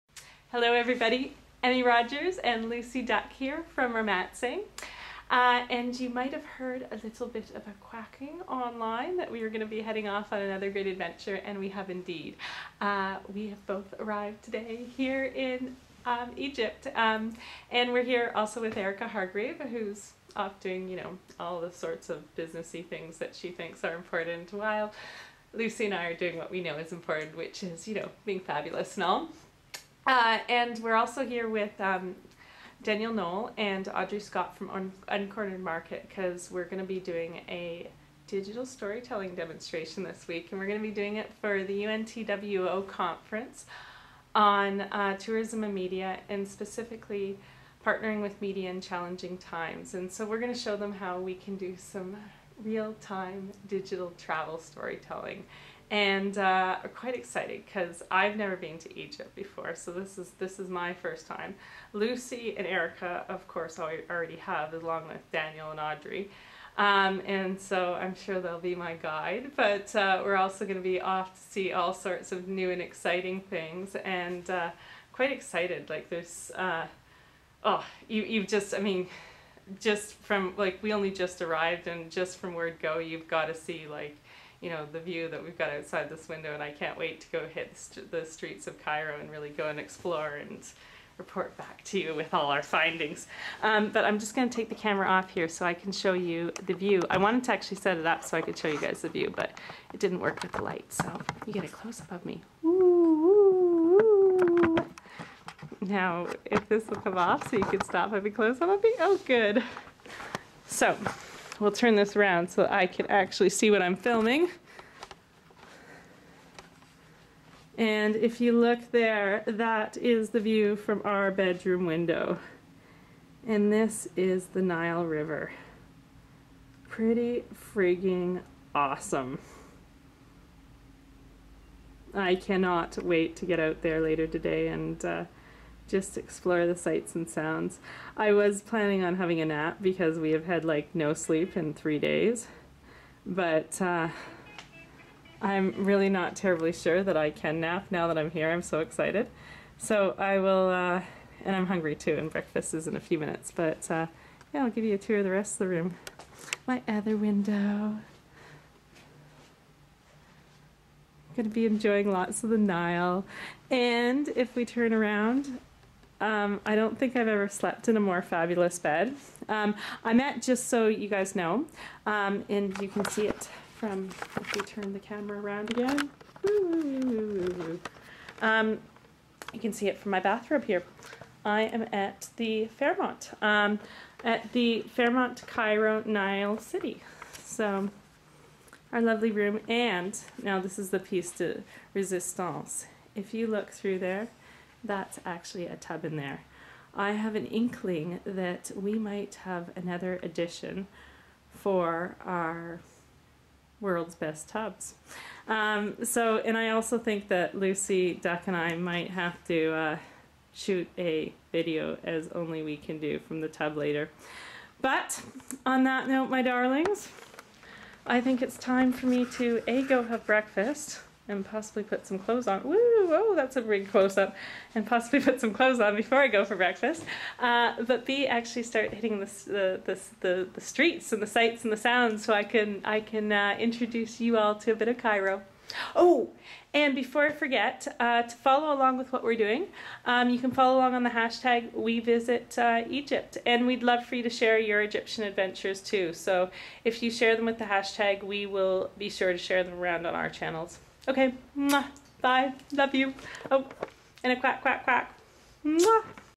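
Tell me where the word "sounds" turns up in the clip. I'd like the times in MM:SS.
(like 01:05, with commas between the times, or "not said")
02:17, 03:51.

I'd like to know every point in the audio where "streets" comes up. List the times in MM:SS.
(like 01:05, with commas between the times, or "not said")
01:28, 03:50.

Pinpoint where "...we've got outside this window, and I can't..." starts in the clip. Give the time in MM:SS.
01:25.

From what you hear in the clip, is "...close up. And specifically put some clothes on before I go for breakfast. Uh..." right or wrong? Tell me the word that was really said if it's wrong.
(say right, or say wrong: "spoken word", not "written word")
wrong: "possibly", not "specifically".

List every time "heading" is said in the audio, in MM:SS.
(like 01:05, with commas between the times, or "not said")
00:09.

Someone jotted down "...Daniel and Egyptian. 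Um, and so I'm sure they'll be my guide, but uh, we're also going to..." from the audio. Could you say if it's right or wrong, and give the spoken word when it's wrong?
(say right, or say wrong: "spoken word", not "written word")
wrong: "Audrey", not "Egyptian".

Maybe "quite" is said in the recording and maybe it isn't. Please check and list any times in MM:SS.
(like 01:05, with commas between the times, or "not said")
00:56, 01:15.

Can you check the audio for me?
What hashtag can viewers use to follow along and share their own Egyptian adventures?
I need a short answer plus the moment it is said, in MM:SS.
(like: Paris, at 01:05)
#WeVisitEgypt, at 04:01.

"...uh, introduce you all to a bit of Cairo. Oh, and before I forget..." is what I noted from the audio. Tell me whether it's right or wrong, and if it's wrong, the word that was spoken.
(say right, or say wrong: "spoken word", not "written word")
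right.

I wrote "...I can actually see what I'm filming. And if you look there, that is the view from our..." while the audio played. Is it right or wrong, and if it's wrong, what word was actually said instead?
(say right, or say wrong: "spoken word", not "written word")
right.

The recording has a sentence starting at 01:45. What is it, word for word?
Now, if this will come off so you can stop, having close-up of me.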